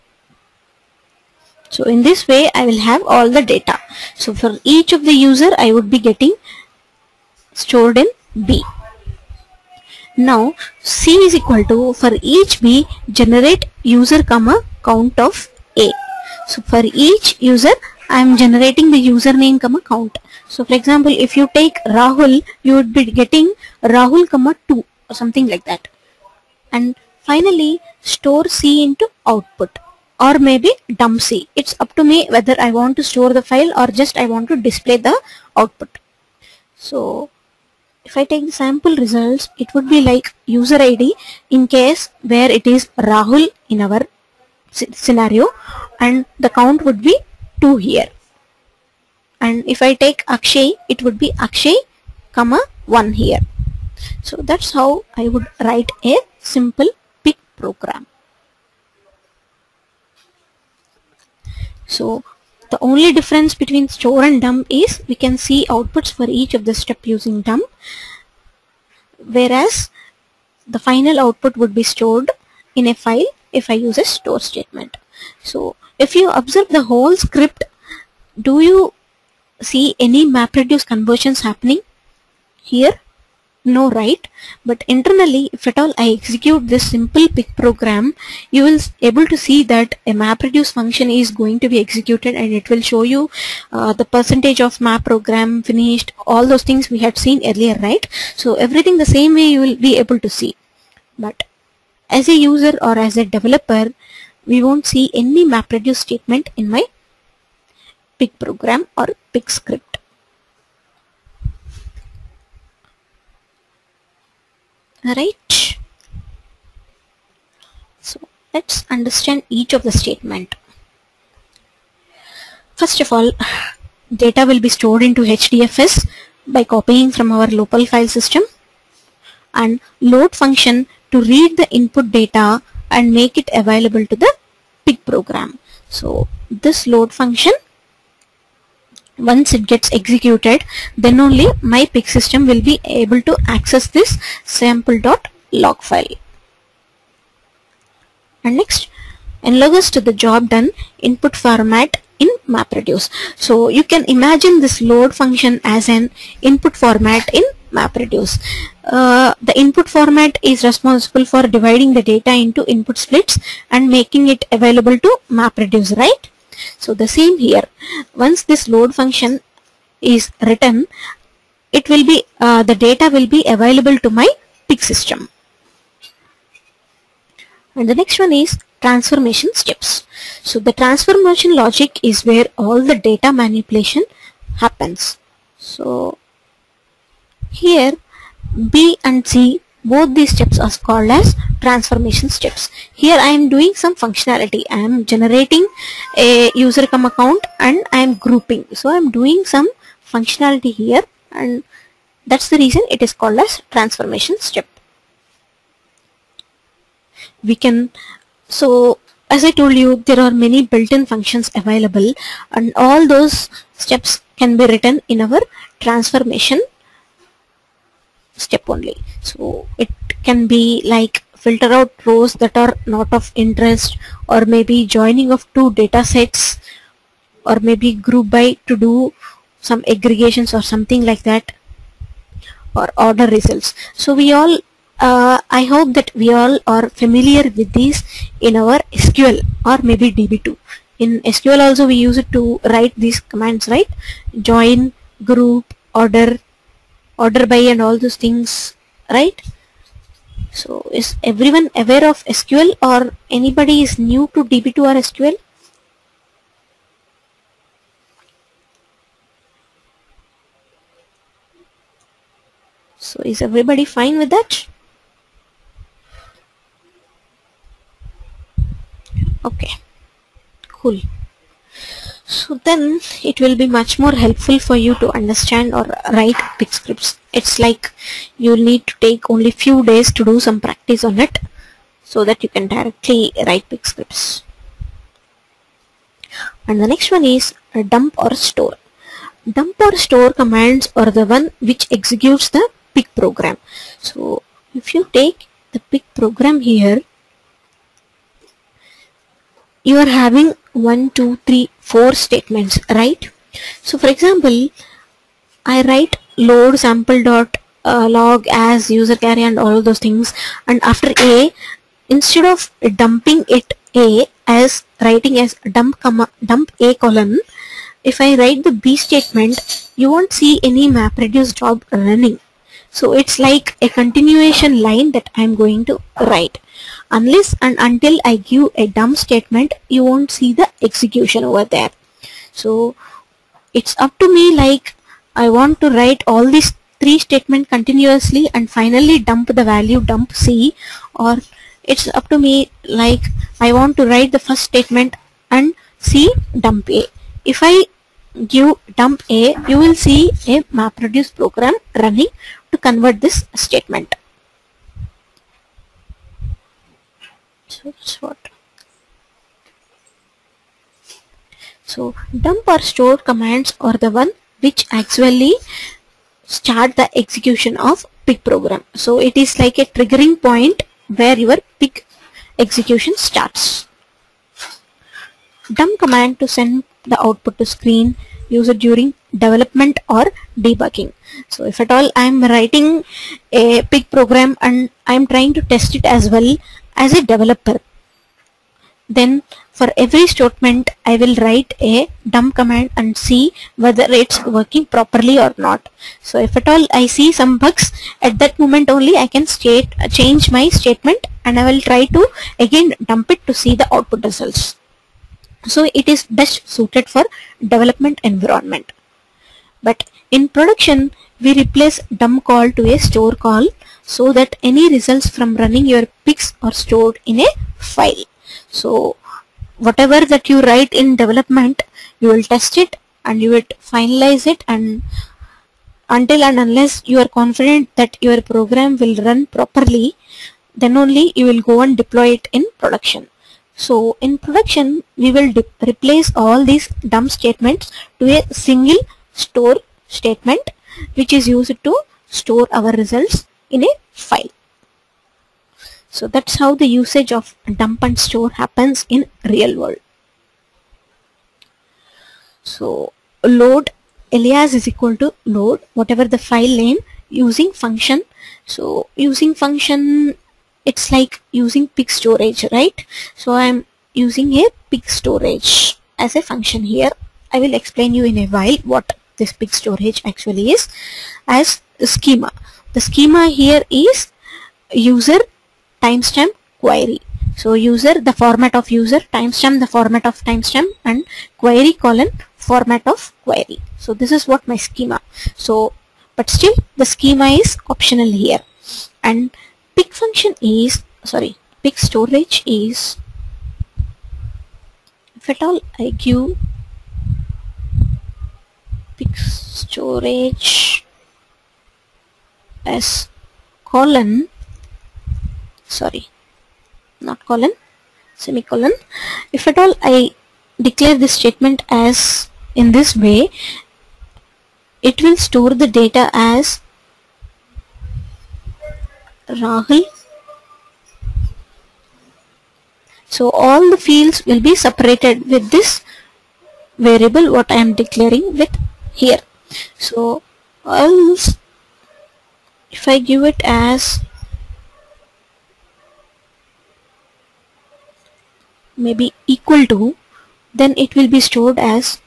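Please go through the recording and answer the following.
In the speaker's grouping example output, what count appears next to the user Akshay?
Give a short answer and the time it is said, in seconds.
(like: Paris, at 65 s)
1, at 51 s.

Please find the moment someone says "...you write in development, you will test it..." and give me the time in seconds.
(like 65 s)
420 s.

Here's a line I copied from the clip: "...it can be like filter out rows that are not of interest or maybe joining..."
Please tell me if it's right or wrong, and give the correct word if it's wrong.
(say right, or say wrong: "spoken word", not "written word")
right.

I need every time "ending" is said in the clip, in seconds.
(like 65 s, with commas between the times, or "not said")
not said.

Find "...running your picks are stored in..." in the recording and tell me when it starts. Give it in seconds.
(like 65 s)
415 s.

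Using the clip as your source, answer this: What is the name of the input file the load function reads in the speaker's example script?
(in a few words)
sample.log.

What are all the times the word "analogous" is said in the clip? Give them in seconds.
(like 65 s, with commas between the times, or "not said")
149 s.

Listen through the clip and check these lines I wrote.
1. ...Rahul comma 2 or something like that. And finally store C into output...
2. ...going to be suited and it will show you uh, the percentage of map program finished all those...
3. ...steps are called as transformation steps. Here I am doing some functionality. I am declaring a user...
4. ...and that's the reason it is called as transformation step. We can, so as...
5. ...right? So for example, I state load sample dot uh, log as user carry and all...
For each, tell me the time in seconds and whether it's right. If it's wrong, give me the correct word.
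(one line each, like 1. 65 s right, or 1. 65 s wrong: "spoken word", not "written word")
1. 23 s right
2. 91 s wrong: "executed", not "suited"
3. 190 s wrong: "generating", not "declaring"
4. 201 s right
5. 302 s wrong: "write", not "state".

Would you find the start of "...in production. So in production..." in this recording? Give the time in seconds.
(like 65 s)
432 s.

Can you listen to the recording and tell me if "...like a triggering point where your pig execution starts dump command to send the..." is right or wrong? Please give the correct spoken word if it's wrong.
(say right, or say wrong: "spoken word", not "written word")
right.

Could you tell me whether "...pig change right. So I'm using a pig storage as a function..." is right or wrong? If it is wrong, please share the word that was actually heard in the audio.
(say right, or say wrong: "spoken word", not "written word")
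wrong: "storage", not "change".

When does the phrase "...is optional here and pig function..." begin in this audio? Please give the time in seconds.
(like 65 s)
487 s.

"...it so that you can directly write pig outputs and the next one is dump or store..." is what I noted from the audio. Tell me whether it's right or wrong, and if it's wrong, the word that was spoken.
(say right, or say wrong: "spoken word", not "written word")
wrong: "scripts", not "outputs".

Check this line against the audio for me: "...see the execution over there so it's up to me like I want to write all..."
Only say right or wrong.
right.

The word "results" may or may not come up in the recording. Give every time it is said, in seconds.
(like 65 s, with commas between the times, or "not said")
38 s, 233 s, 404 s, 414 s, 442 s.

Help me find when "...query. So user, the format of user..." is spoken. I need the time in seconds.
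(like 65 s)
476 s.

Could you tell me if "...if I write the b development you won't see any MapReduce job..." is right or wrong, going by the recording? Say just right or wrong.
wrong.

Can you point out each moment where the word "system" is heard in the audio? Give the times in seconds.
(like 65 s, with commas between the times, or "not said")
128 s, 142 s, 174 s.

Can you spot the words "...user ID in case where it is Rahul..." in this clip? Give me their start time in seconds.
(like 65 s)
40 s.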